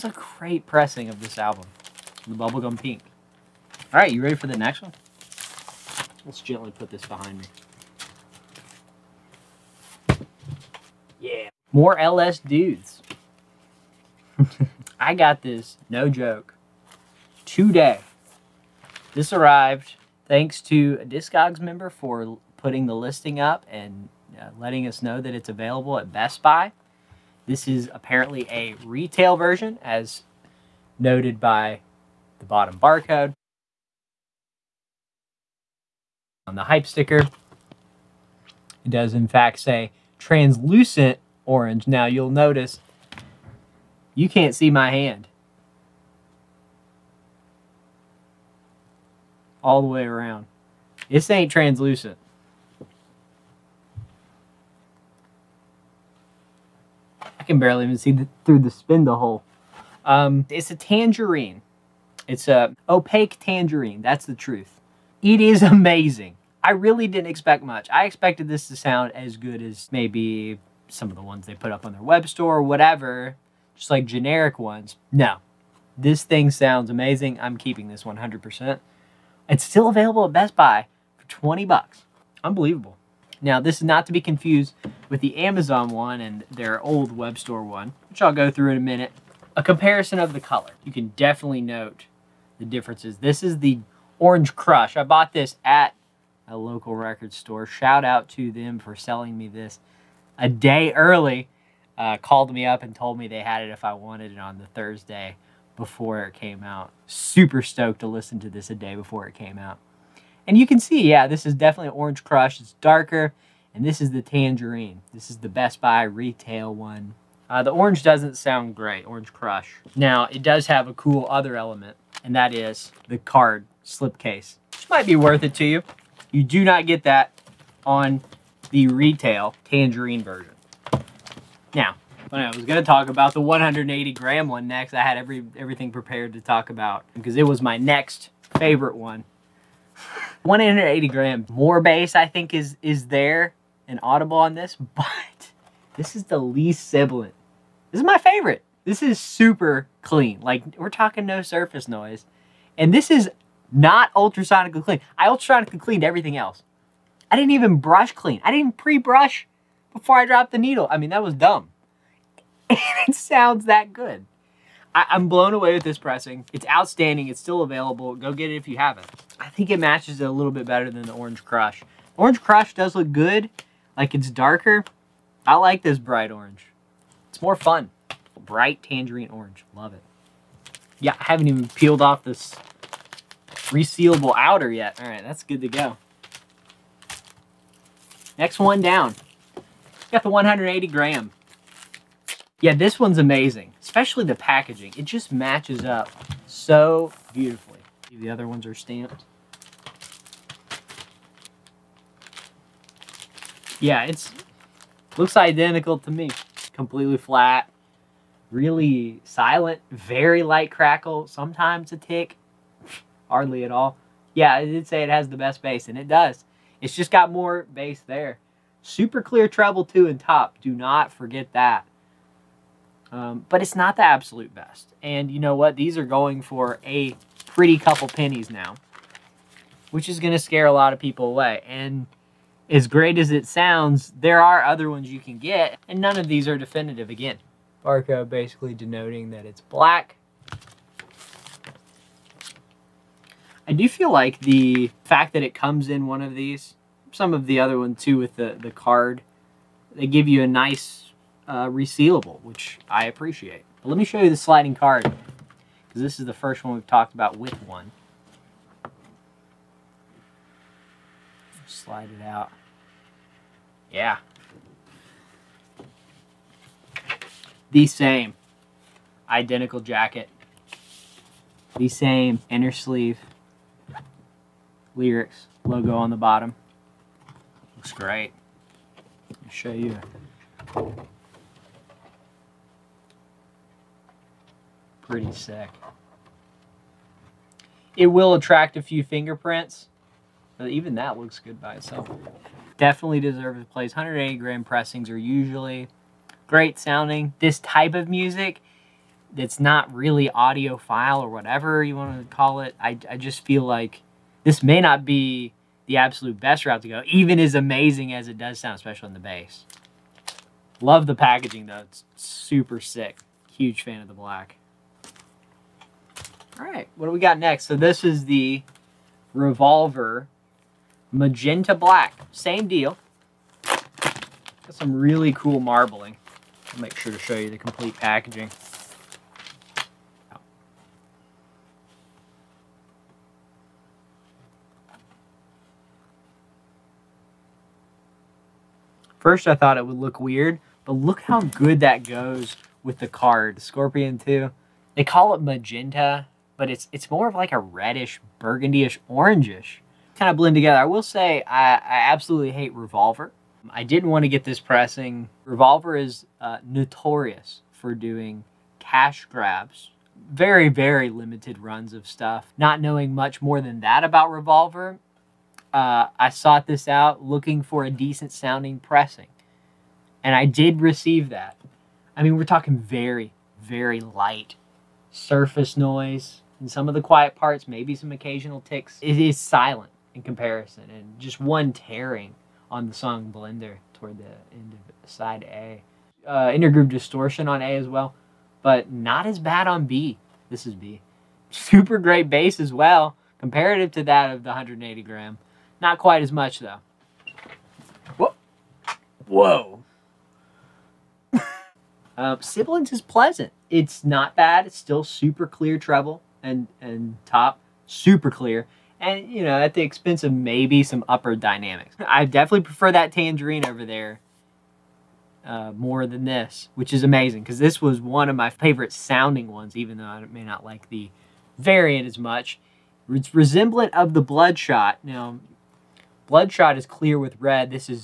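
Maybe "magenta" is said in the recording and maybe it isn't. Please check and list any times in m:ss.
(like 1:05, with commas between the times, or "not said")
5:21, 5:45.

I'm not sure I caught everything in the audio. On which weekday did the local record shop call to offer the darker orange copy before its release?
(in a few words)
Thursday.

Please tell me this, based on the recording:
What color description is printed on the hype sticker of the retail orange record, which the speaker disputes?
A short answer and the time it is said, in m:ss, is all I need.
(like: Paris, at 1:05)
Translucent orange, at 0:40.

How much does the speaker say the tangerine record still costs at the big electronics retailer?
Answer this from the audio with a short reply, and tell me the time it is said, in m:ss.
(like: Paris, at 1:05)
$20, at 1:21.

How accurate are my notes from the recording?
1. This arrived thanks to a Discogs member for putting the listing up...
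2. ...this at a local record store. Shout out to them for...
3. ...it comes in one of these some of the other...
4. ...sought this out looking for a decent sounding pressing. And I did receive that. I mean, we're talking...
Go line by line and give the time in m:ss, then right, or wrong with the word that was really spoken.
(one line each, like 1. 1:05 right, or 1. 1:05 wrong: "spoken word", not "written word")
1. 0:19 right
2. 1:35 right
3. 4:05 right
4. 6:06 right.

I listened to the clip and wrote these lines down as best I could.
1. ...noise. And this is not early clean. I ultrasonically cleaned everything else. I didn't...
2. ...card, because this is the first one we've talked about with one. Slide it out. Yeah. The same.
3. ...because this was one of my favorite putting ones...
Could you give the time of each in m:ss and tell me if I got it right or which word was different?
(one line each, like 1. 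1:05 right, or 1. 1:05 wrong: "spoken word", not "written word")
1. 2:31 wrong: "ultrasonically", not "early"
2. 4:14 right
3. 6:57 wrong: "sounding", not "putting".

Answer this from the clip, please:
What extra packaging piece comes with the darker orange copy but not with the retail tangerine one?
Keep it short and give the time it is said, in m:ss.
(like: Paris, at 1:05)
Card slipcase, at 2:03.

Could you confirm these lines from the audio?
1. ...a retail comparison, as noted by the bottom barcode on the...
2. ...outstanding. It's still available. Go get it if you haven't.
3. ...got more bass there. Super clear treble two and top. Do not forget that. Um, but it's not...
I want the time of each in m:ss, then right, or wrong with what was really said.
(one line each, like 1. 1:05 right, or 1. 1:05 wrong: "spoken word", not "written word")
1. 0:28 wrong: "version", not "comparison"
2. 2:46 right
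3. 3:37 right.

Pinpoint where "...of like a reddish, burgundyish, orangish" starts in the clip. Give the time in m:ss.
5:47.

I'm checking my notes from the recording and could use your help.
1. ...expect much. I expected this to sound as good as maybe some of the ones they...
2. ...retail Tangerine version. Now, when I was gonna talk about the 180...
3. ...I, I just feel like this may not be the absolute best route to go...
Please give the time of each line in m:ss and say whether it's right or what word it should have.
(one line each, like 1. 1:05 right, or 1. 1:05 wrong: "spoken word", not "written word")
1. 1:07 right
2. 2:08 right
3. 5:02 right.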